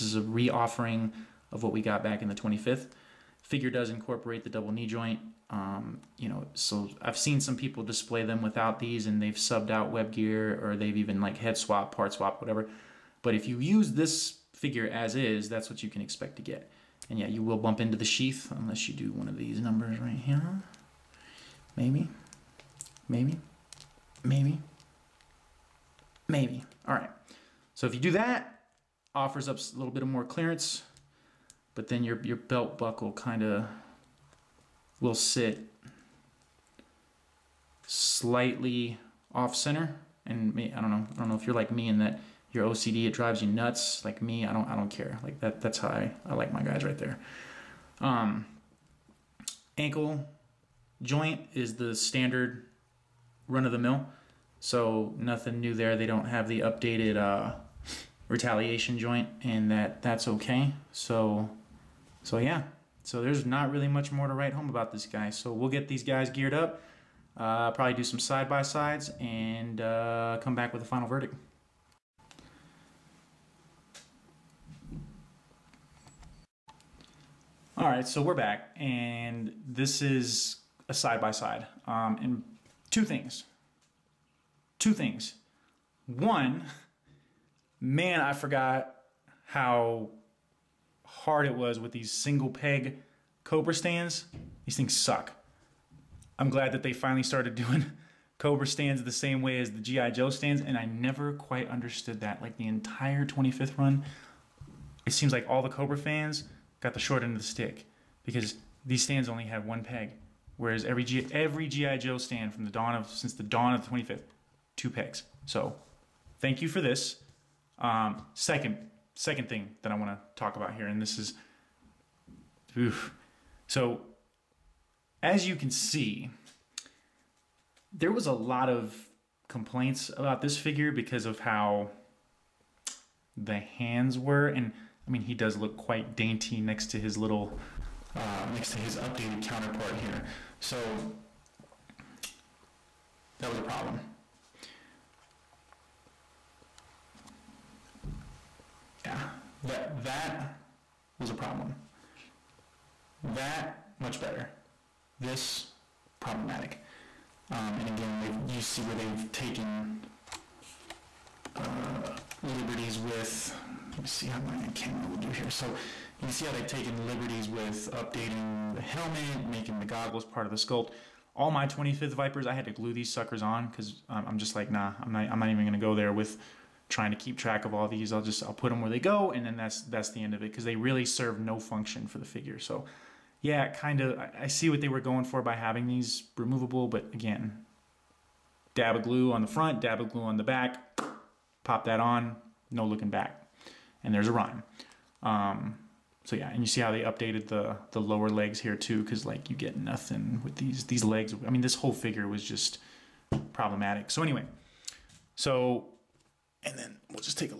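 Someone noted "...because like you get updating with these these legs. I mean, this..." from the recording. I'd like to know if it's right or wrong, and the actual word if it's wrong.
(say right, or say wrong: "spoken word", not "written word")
wrong: "nothing", not "updating".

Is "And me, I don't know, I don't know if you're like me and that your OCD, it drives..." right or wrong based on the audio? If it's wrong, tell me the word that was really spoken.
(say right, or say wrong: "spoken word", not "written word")
right.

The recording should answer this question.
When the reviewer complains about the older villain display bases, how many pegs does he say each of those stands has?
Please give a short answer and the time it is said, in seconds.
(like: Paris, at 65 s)
1, at 109 s.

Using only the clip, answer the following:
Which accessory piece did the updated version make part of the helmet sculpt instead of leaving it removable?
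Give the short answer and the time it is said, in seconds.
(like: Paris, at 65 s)
The goggles, at 169 s.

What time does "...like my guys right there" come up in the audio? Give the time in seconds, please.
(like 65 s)
46 s.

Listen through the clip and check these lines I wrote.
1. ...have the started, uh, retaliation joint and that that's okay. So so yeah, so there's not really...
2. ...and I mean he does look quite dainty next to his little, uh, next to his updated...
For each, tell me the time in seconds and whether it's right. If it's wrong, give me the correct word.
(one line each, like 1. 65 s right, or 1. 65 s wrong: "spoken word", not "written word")
1. 56 s wrong: "updated", not "started"
2. 134 s right.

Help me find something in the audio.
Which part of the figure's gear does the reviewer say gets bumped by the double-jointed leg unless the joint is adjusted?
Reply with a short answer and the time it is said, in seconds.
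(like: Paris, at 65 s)
The sheath, at 18 s.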